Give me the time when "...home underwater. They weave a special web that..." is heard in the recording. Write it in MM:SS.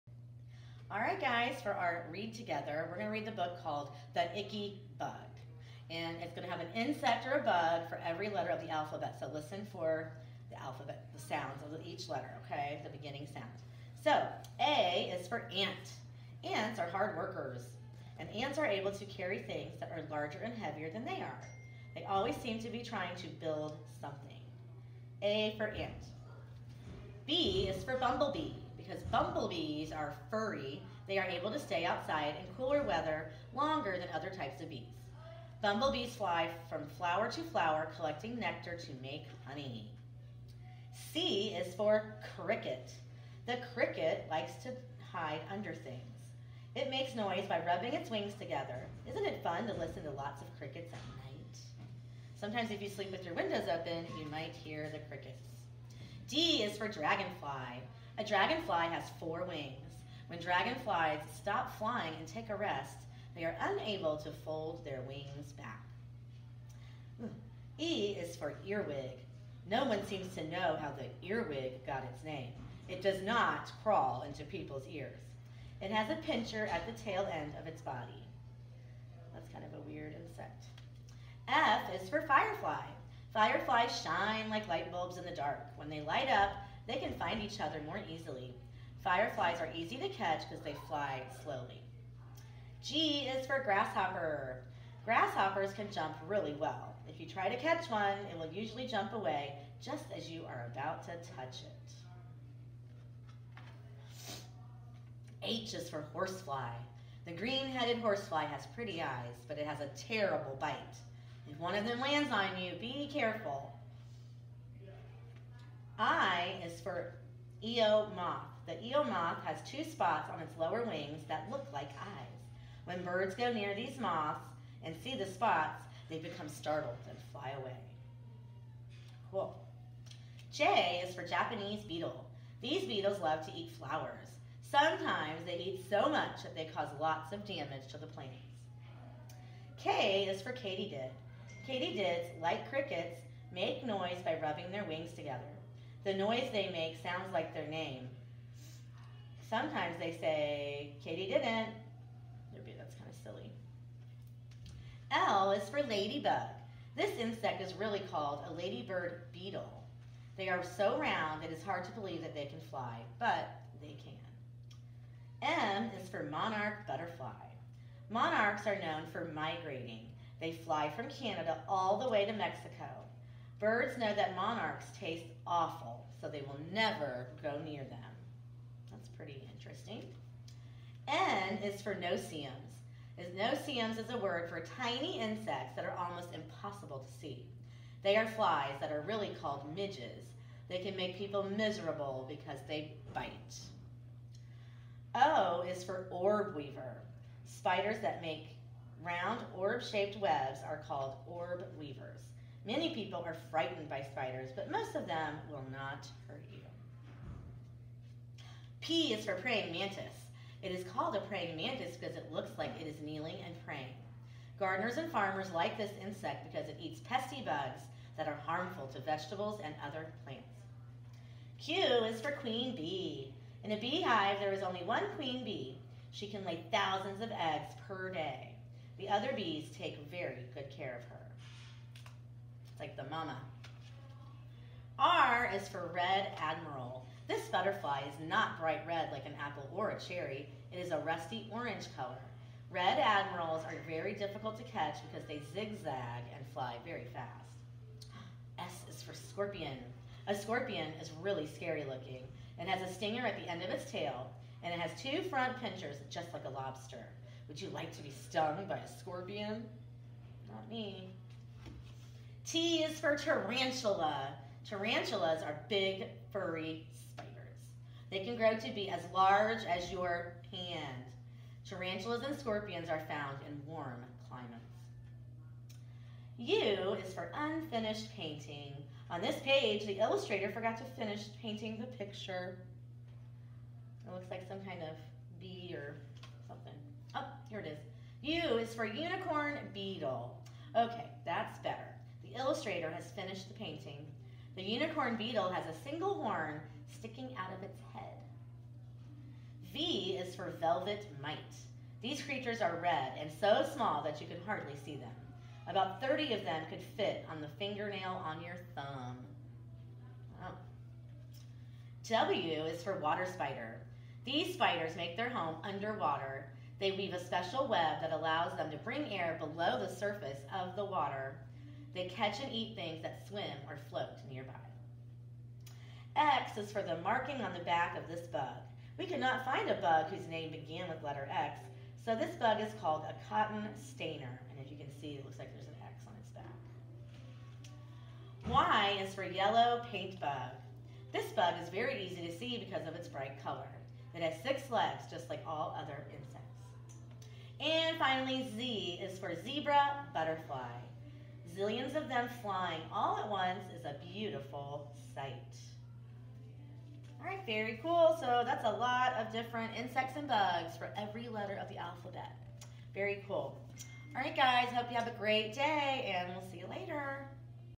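05:15.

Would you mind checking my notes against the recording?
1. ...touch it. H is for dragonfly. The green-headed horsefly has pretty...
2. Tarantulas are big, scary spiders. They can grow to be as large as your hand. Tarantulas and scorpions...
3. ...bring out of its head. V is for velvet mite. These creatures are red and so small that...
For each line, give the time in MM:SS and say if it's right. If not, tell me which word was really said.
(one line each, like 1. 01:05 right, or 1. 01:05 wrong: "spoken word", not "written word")
1. 01:41 wrong: "horsefly", not "dragonfly"
2. 04:24 wrong: "furry", not "scary"
3. 04:56 wrong: "sticking", not "bring".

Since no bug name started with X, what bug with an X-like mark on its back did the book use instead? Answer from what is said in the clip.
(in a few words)
cotton stainer.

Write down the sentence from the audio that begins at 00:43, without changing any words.
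The cricket likes to hide under things.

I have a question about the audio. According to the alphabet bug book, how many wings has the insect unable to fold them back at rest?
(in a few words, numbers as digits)
4.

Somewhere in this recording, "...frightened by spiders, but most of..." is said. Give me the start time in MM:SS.
03:23.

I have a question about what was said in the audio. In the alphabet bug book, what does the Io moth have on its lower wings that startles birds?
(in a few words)
two spots.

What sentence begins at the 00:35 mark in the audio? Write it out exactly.
Bumblebees fly from flower to flower, collecting nectar to make honey.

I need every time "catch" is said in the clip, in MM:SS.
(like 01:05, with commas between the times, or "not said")
01:30, 01:37, 04:04, 05:22.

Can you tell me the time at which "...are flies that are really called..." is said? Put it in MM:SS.
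03:08.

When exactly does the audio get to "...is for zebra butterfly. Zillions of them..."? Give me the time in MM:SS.
05:49.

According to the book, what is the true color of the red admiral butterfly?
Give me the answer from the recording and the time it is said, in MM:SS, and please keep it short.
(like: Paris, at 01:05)
rusty orange, at 04:00.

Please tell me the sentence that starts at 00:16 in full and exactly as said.
Ants are hard workers, and ants are able to carry things that are larger and heavier than they are.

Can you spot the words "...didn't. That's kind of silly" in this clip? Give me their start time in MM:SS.
02:31.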